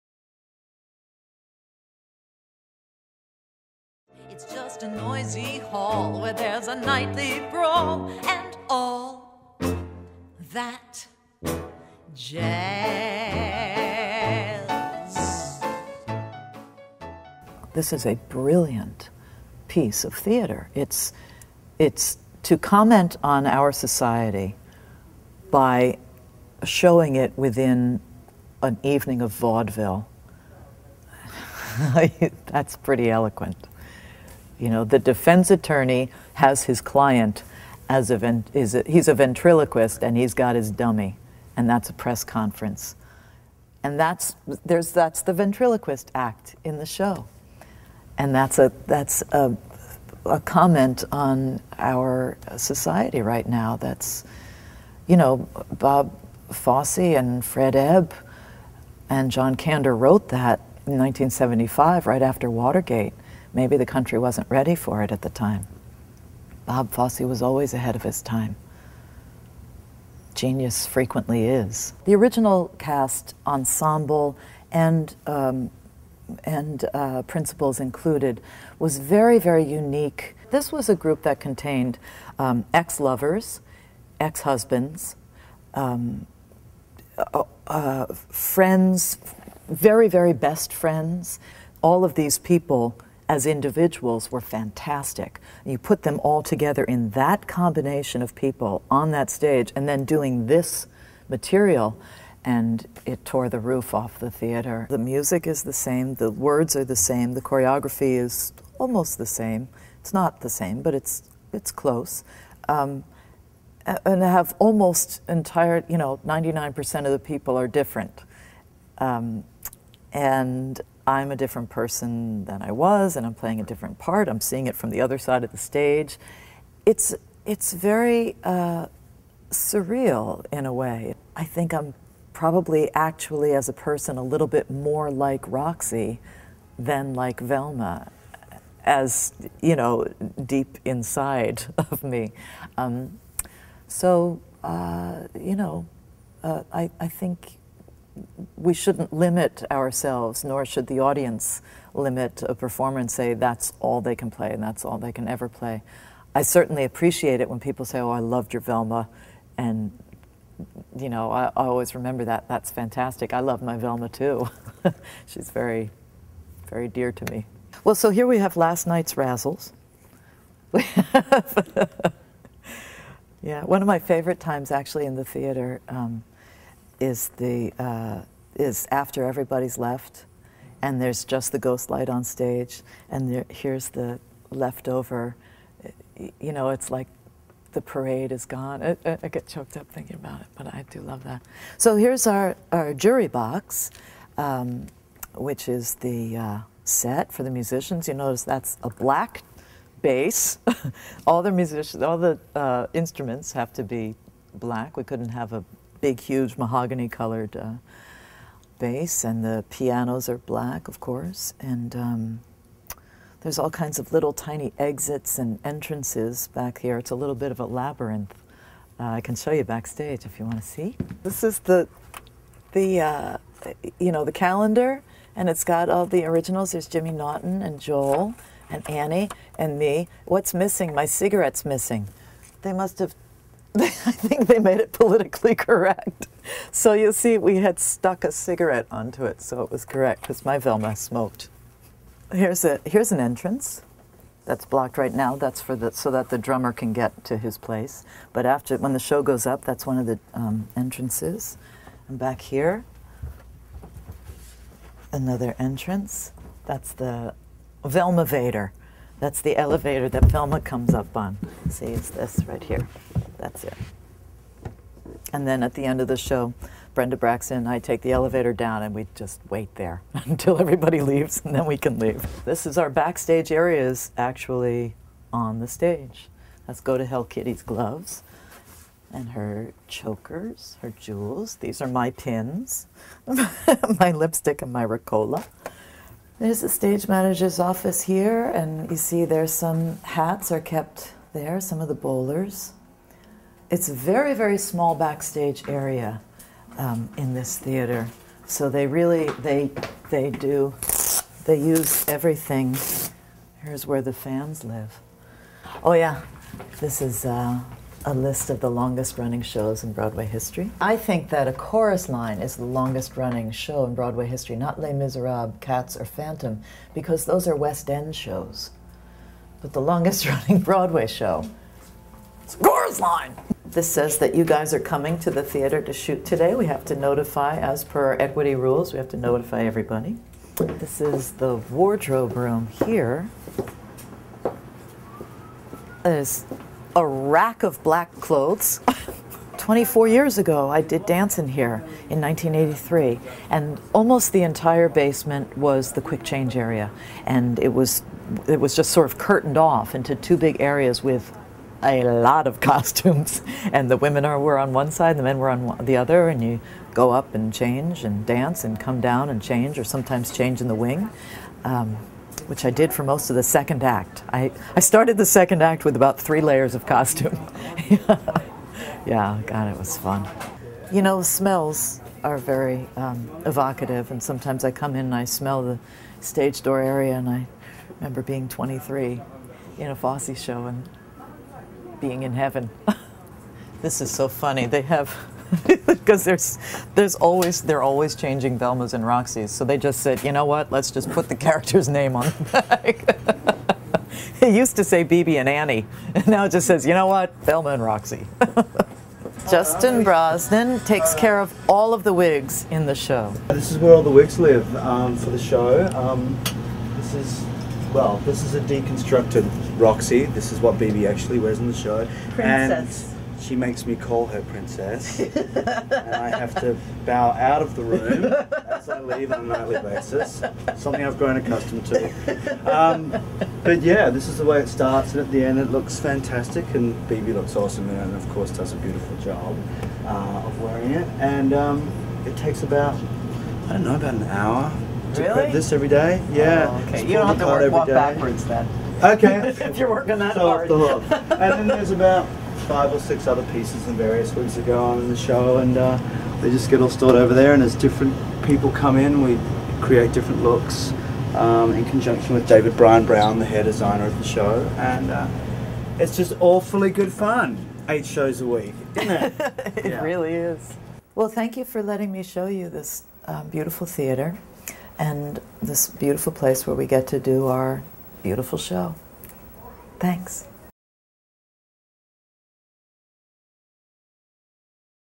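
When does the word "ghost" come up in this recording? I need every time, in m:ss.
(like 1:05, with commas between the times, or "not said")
3:01.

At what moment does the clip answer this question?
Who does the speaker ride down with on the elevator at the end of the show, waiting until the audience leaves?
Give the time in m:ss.
4:26.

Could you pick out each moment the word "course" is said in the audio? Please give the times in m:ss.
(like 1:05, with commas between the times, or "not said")
3:30, 7:08.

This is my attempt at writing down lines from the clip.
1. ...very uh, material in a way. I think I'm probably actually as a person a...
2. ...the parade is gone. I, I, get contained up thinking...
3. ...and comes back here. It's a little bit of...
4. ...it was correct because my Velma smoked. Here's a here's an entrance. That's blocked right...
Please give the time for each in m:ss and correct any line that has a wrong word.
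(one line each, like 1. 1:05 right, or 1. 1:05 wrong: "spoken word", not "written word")
1. 2:07 wrong: "surreal", not "material"
2. 3:07 wrong: "choked", not "contained"
3. 3:35 wrong: "entrances", not "comes"
4. 3:59 right.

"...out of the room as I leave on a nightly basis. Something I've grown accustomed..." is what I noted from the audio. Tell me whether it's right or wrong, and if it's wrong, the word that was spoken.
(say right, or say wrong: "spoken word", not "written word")
right.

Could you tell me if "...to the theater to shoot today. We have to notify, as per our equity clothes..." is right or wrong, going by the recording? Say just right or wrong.
wrong.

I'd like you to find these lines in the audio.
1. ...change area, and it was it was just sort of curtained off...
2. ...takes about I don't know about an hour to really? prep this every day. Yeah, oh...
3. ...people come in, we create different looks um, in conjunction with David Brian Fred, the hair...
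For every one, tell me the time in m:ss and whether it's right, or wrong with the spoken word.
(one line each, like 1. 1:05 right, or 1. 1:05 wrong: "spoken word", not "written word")
1. 5:46 right
2. 7:12 right
3. 7:28 wrong: "Brown", not "Fred".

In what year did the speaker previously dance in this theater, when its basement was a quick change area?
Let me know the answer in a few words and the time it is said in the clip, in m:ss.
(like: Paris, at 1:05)
1983, at 5:42.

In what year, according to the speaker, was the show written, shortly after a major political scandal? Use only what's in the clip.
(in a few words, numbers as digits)
1975.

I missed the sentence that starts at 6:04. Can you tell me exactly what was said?
I, I started the second act with about three layers of costume.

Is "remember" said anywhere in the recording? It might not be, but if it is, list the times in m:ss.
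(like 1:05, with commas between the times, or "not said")
2:41, 6:17.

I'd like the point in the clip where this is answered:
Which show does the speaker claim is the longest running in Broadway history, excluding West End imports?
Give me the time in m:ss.
5:11.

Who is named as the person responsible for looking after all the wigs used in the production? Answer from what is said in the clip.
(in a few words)
Justin Brosnan.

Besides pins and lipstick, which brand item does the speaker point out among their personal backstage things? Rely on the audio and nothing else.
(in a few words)
Ricola.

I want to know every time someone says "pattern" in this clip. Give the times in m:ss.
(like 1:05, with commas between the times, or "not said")
not said.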